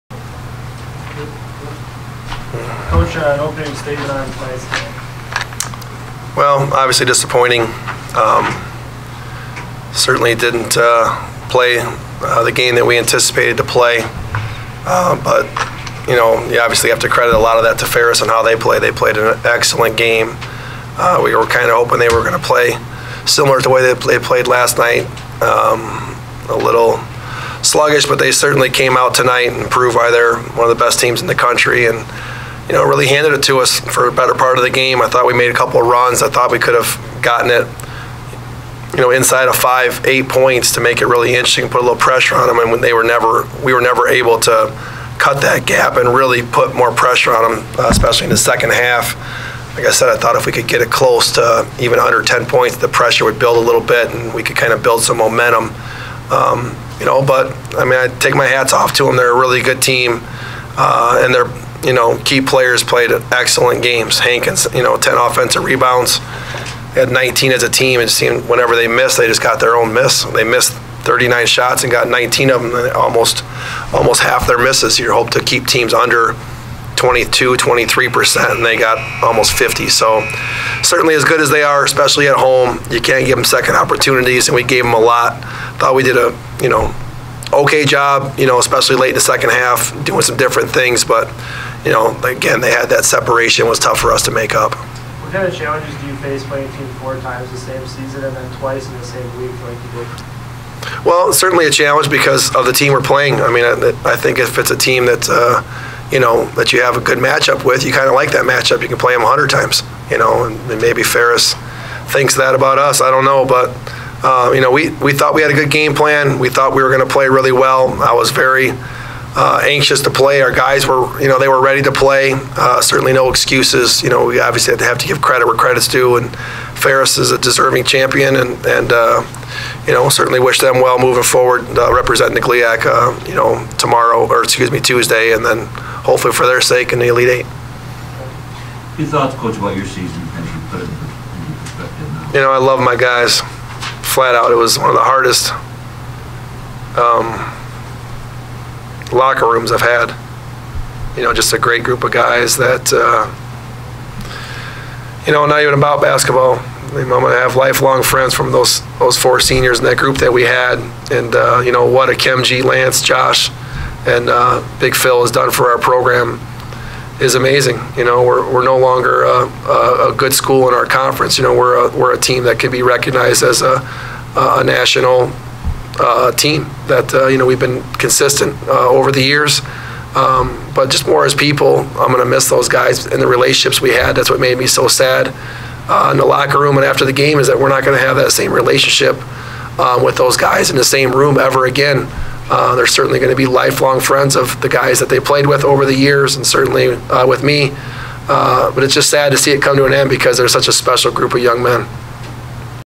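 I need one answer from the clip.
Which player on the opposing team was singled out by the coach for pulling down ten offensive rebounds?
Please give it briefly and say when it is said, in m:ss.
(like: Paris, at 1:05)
Hankins, at 1:04.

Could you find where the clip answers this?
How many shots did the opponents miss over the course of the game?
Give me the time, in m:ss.
1:11.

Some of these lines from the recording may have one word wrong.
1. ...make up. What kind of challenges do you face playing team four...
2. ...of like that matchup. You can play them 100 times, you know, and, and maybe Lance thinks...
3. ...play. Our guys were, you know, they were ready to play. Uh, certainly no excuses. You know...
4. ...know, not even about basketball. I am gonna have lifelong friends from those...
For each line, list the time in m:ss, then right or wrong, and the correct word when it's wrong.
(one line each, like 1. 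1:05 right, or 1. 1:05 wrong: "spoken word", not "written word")
1. 1:34 right
2. 1:48 wrong: "Ferris", not "Lance"
3. 2:00 right
4. 2:35 right.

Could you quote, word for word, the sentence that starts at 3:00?
Um, but just more as people, I'm going to miss those guys and the relationships we had.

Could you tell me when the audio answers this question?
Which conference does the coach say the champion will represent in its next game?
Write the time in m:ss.
2:12.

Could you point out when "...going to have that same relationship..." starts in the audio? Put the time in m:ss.
3:07.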